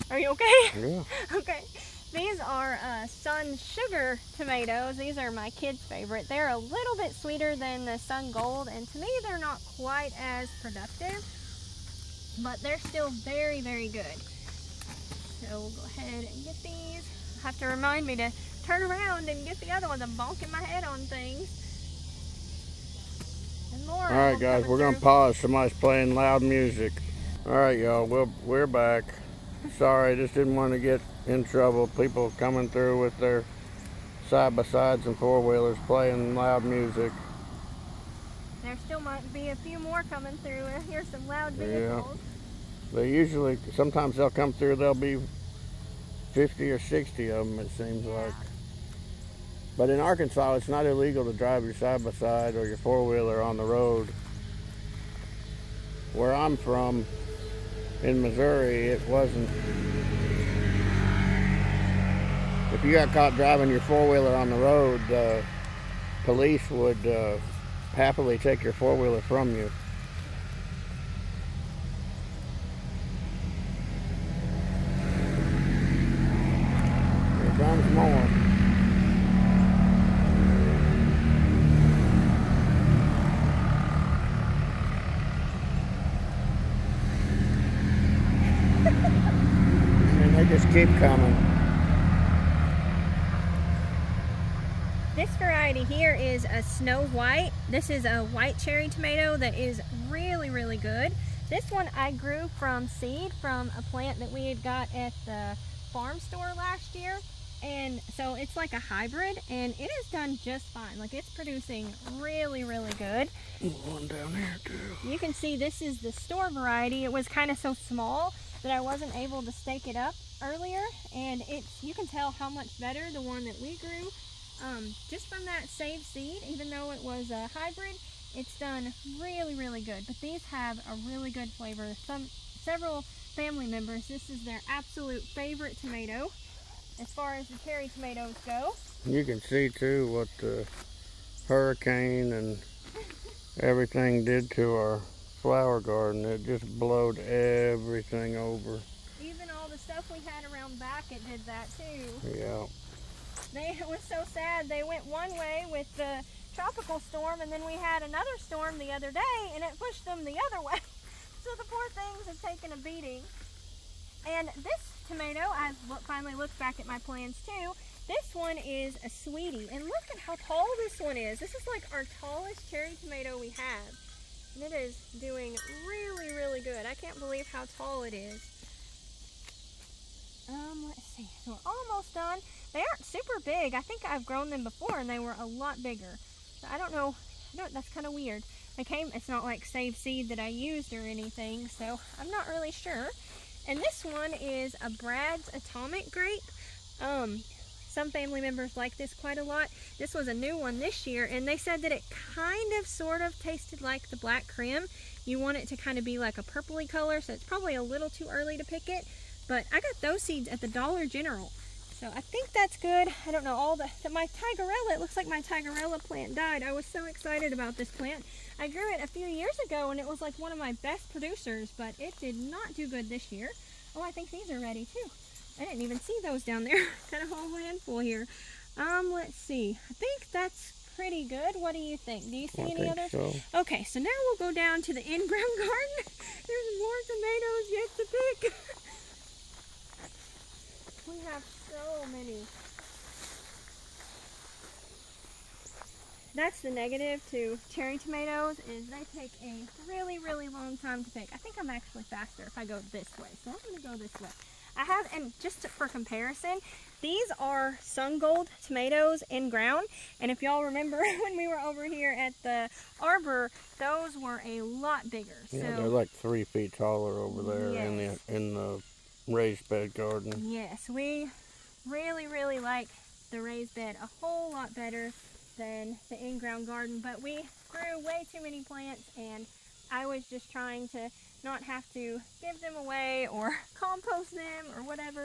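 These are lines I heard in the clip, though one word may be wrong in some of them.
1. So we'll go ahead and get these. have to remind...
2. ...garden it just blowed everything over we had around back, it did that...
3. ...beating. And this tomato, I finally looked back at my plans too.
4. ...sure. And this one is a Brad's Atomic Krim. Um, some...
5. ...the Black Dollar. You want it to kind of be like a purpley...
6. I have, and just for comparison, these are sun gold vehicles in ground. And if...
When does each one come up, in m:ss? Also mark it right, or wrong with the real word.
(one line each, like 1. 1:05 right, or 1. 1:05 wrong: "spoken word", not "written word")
1. 0:15 right
2. 2:25 right
3. 2:42 right
4. 3:12 wrong: "Grape", not "Krim"
5. 3:24 wrong: "Krim", not "Dollar"
6. 4:14 wrong: "tomatoes", not "vehicles".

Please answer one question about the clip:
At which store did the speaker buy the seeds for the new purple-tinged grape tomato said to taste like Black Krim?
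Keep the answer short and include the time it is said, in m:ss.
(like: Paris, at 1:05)
Dollar General, at 3:30.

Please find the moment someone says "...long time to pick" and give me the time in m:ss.
4:10.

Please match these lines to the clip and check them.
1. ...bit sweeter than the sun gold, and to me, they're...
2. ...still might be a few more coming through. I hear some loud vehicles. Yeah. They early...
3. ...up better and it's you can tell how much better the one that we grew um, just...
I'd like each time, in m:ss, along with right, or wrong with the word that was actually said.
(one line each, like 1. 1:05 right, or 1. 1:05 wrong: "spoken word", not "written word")
1. 0:06 right
2. 0:38 wrong: "usually", not "early"
3. 1:59 wrong: "earlier", not "better".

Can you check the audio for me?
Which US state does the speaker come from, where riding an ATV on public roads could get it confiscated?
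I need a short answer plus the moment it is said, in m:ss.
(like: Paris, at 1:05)
Missouri, at 0:58.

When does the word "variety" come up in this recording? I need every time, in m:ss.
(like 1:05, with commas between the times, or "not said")
1:35, 1:56.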